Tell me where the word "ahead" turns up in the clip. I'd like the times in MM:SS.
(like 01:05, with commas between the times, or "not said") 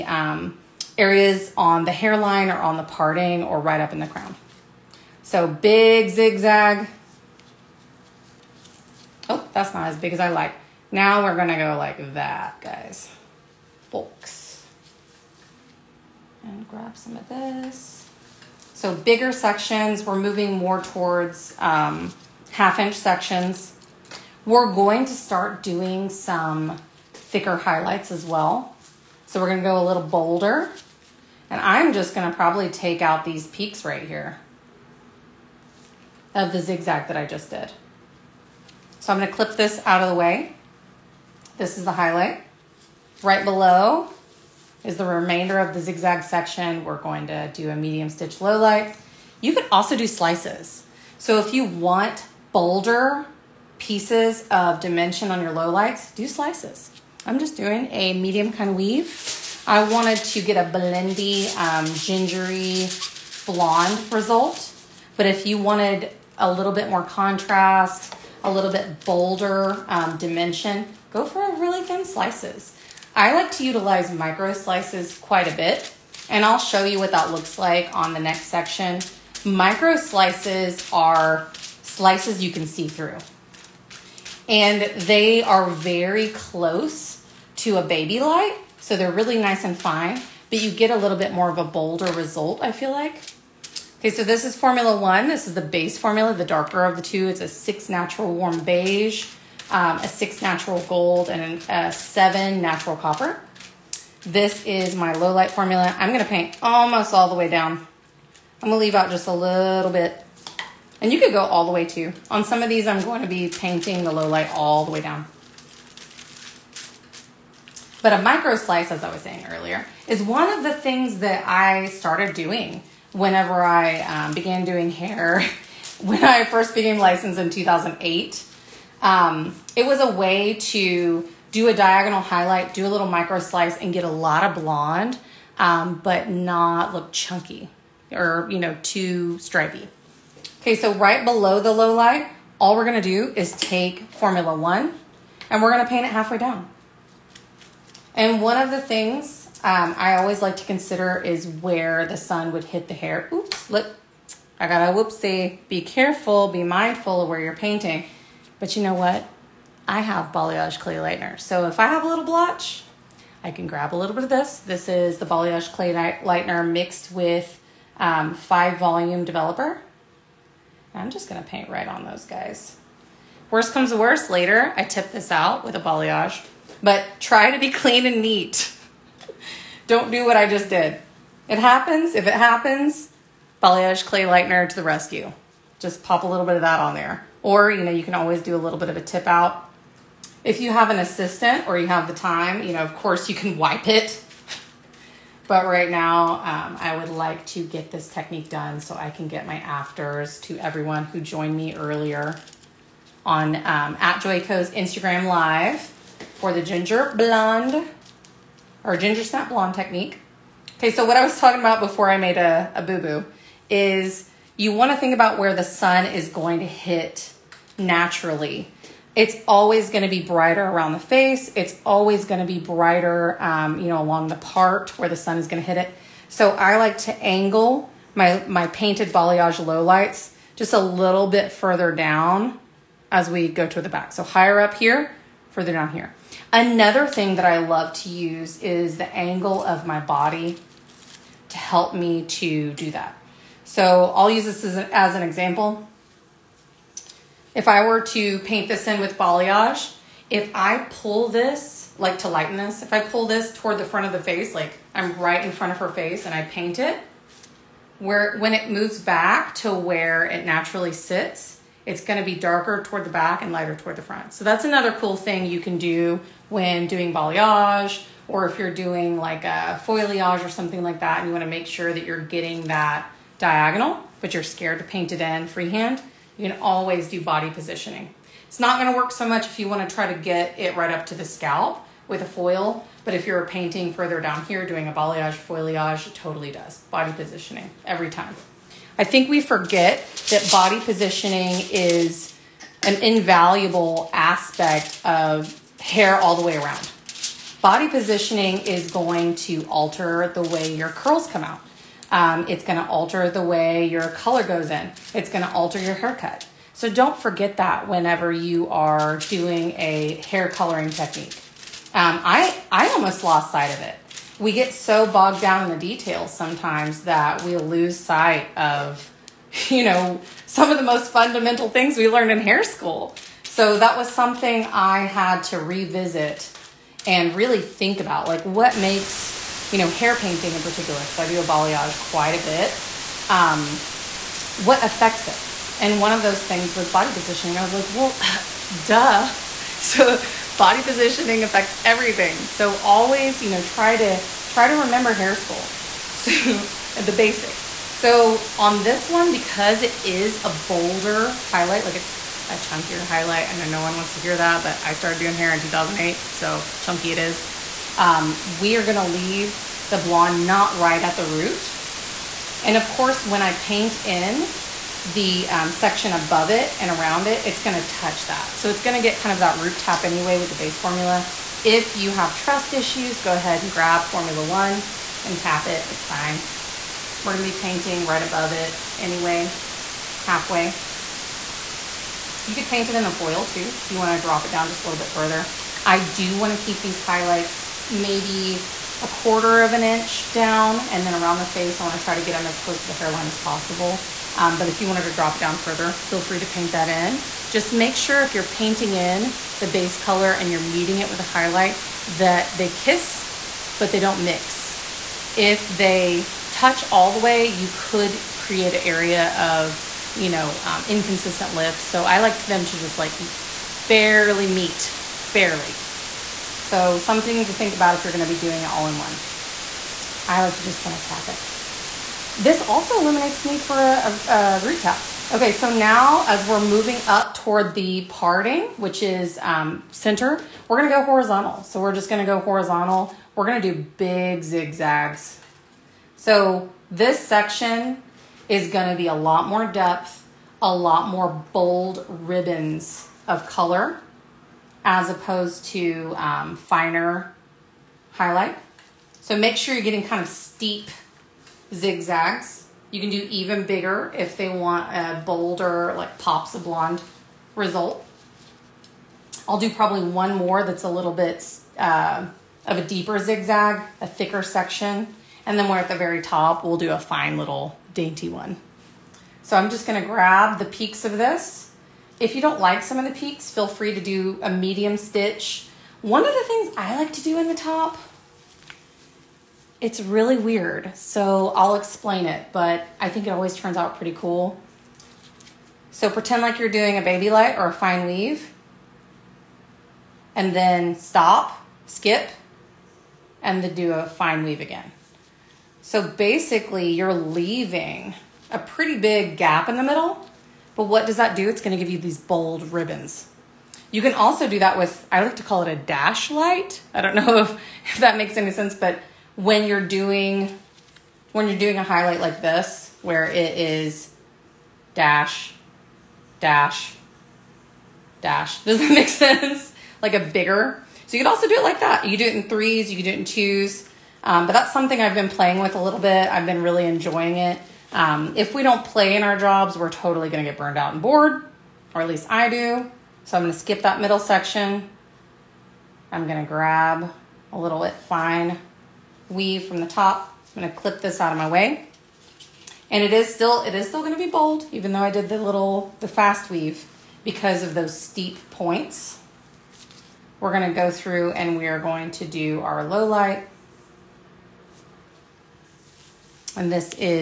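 06:13.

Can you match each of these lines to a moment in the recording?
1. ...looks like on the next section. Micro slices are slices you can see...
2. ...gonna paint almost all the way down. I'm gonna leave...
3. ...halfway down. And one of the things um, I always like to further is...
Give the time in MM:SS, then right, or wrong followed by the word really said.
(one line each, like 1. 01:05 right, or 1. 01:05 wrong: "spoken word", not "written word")
1. 01:17 right
2. 01:46 right
3. 02:26 wrong: "consider", not "further".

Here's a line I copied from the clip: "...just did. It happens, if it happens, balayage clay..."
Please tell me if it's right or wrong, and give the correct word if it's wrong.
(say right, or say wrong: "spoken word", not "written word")
right.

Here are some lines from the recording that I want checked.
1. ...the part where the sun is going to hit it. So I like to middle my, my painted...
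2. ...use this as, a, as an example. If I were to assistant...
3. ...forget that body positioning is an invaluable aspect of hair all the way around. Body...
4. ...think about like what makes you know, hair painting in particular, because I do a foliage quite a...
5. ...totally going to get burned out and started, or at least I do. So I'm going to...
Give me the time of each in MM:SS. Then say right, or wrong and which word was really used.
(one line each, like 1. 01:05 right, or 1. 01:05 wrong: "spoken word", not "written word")
1. 03:44 wrong: "angle", not "middle"
2. 04:04 wrong: "paint", not "assistant"
3. 04:49 right
4. 05:27 wrong: "balayage", not "foliage"
5. 08:49 wrong: "bored", not "started".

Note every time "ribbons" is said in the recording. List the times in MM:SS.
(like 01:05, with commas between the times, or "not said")
07:22, 08:22.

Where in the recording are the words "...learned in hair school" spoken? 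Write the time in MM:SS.
05:22.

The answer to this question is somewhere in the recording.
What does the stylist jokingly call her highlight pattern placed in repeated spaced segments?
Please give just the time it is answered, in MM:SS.
08:25.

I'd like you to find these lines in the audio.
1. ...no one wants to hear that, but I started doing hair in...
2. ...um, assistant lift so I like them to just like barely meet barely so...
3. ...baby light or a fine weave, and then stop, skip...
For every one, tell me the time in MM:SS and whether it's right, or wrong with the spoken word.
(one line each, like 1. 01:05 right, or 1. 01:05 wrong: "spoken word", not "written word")
1. 05:53 right
2. 06:50 wrong: "inconsistent", not "assistant"
3. 08:07 right.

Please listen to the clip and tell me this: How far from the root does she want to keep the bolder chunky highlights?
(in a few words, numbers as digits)
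a quarter of an inch.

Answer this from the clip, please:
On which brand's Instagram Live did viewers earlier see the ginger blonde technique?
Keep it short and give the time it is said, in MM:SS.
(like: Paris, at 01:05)
Joico, at 03:24.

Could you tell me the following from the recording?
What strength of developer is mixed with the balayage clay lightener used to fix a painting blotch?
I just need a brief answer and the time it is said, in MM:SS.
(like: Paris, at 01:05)
5 volume, at 02:48.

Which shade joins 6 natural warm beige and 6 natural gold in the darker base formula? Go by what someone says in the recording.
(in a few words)
7 natural copper.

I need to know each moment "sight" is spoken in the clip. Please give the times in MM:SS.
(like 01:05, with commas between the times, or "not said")
05:13, 05:17.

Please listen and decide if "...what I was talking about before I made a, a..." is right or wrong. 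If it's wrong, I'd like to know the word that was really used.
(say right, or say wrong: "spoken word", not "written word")
right.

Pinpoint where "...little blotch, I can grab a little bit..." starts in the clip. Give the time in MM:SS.
02:42.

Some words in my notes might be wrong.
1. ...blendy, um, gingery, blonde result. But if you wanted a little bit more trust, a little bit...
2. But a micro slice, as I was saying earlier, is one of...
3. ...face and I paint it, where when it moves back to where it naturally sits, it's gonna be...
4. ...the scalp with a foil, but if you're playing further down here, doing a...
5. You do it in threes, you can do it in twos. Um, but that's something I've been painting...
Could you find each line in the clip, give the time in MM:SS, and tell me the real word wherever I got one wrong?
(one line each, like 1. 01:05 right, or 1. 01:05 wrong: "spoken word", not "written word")
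1. 01:00 wrong: "contrast", not "trust"
2. 01:58 right
3. 04:15 right
4. 04:41 wrong: "painting", not "playing"
5. 08:42 wrong: "playing", not "painting".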